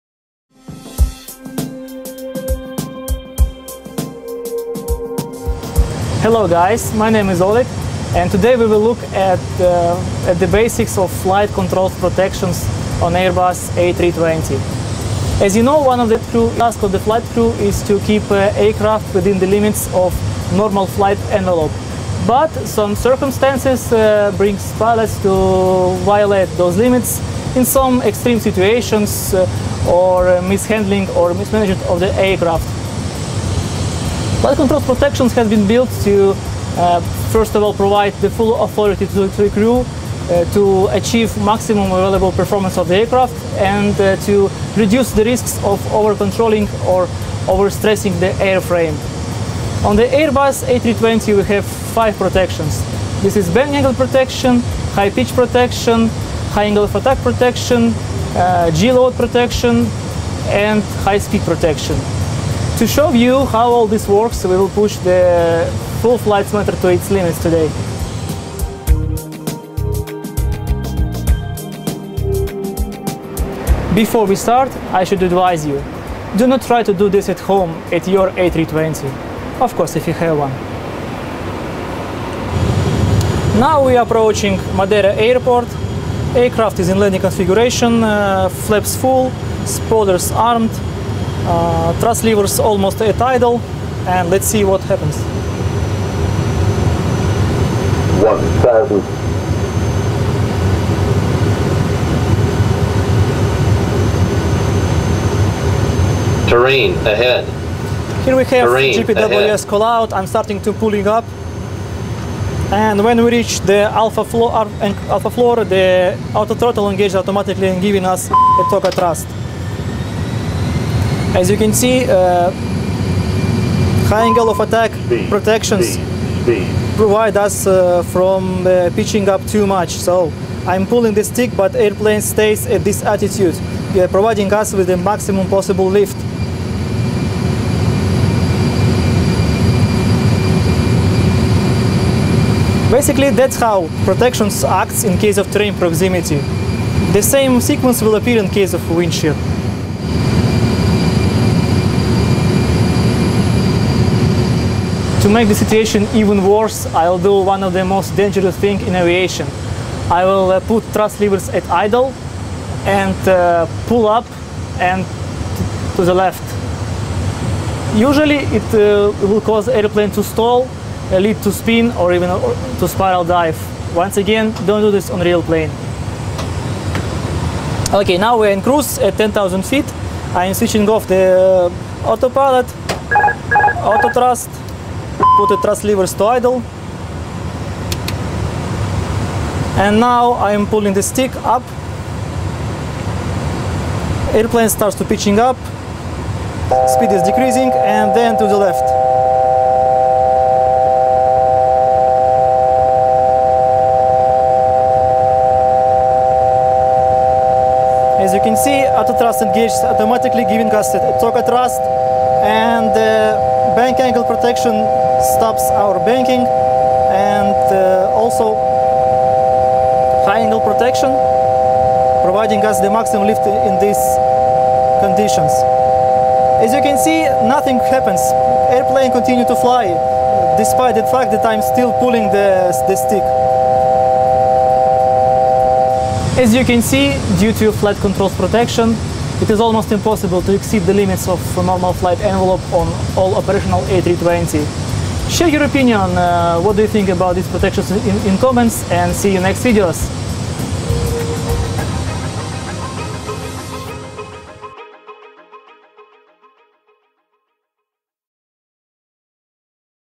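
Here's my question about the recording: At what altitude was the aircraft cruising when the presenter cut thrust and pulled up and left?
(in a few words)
10,000 feet.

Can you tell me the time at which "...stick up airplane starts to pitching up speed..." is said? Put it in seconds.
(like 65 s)
191 s.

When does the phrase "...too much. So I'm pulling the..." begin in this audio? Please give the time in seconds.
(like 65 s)
129 s.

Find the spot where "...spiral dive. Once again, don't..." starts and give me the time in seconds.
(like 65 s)
172 s.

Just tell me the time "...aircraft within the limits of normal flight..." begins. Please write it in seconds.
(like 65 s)
18 s.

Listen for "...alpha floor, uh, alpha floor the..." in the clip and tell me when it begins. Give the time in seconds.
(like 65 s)
113 s.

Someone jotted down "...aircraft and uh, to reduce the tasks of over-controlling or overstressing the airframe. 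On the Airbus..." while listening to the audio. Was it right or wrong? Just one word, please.
wrong.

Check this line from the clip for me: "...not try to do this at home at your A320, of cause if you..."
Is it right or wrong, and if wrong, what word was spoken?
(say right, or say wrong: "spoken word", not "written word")
wrong: "course", not "cause".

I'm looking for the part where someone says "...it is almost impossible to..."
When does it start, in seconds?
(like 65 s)
239 s.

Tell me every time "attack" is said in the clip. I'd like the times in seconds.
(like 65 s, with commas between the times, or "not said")
56 s, 124 s.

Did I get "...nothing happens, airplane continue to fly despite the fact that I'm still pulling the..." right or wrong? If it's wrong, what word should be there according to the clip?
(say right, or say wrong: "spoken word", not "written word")
right.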